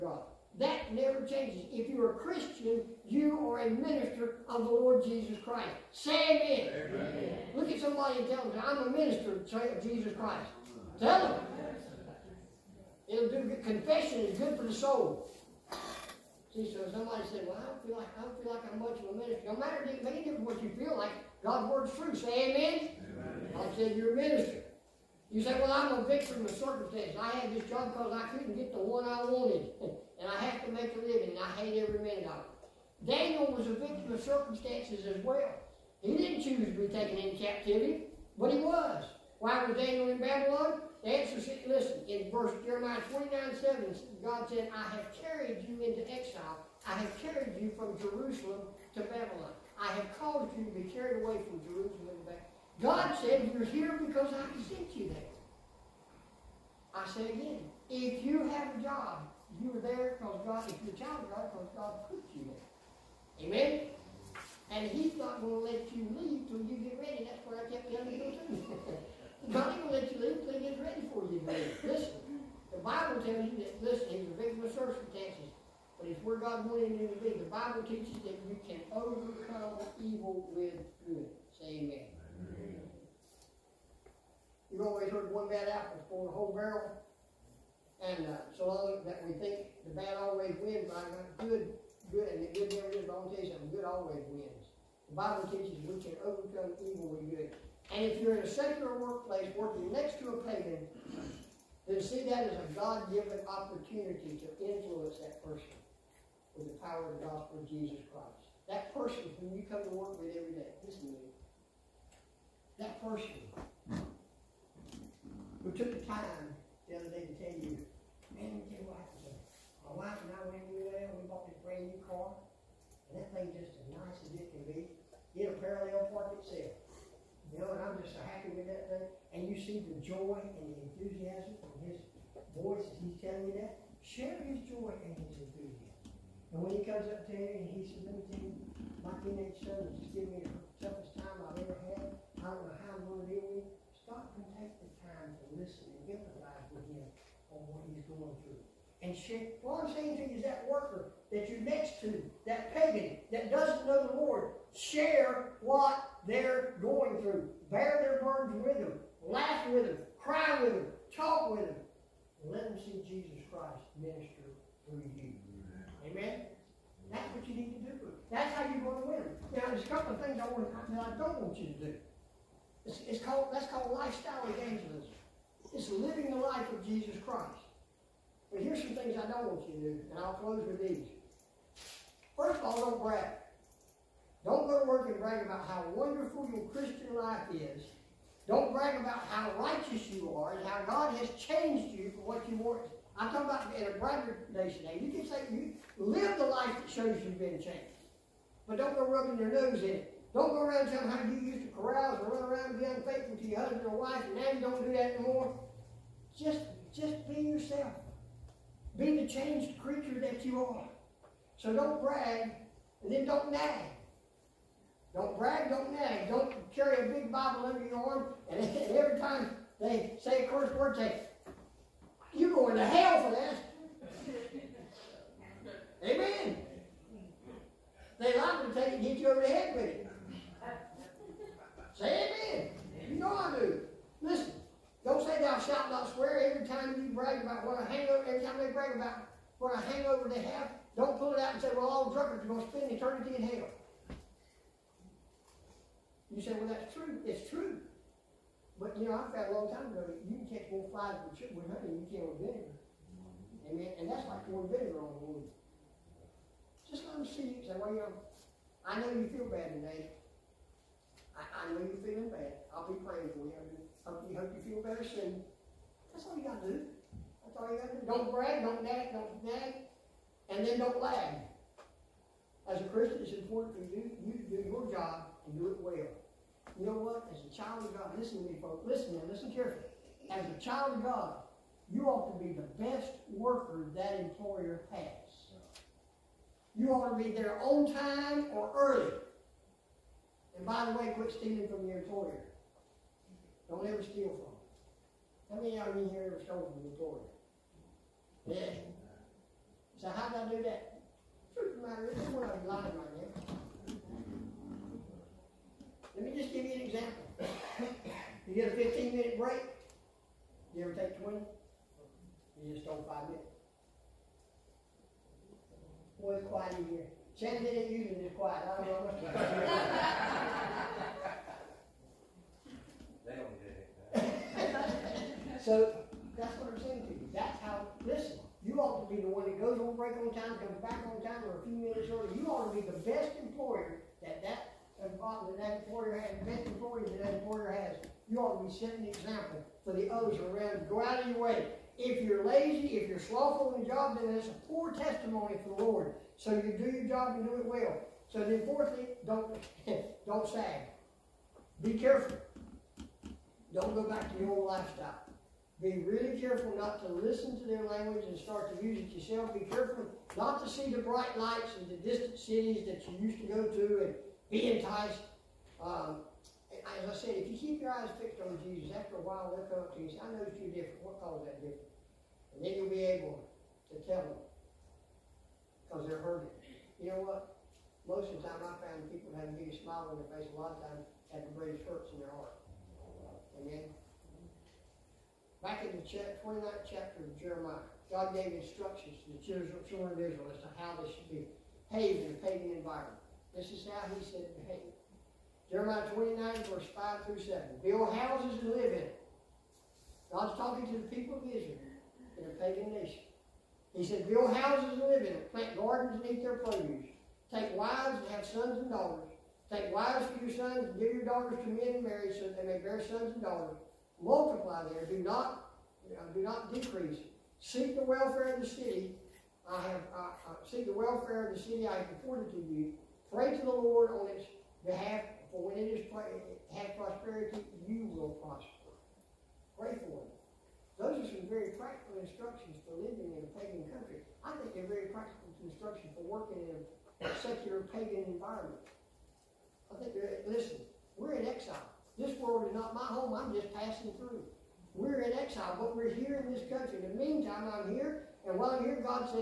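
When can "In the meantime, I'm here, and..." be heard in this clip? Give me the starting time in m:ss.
7:27.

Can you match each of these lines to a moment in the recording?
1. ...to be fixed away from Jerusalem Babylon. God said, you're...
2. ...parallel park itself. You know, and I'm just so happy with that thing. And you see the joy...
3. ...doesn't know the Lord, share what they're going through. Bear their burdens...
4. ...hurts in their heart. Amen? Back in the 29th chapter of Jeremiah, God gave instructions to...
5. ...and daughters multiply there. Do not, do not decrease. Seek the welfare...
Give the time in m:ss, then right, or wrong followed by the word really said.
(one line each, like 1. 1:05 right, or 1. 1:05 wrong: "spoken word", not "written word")
1. 0:50 wrong: "carried", not "fixed"
2. 2:05 right
3. 2:33 right
4. 6:21 right
5. 6:53 right.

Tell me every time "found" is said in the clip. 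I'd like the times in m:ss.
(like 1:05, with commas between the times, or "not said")
4:09, 6:18.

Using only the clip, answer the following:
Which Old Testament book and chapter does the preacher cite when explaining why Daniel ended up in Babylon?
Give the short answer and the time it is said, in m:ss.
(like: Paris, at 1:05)
Jeremiah 29, at 0:42.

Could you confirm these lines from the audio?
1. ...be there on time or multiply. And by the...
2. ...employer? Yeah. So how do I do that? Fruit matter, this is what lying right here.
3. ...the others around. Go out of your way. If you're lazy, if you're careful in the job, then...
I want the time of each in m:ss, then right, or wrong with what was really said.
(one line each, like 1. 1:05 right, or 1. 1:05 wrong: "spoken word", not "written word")
1. 4:47 wrong: "early", not "multiply"
2. 4:56 right
3. 5:39 wrong: "slothful", not "careful".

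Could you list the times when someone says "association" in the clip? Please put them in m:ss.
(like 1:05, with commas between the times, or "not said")
not said.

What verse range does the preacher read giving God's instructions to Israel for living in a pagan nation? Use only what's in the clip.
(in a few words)
5 through 7.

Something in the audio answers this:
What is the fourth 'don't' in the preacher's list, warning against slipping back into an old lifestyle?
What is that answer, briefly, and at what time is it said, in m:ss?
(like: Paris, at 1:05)
don't sag, at 5:50.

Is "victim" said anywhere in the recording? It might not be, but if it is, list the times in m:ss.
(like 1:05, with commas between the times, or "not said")
0:26, 0:33, 1:14.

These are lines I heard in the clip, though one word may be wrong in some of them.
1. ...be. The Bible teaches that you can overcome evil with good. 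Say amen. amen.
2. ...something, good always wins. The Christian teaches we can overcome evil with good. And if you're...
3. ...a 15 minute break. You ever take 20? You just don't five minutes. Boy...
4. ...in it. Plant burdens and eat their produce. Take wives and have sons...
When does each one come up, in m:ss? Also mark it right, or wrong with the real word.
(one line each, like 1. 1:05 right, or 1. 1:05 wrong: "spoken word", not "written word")
1. 1:17 right
2. 1:33 wrong: "Bible", not "Christian"
3. 5:08 right
4. 6:45 wrong: "gardens", not "burdens".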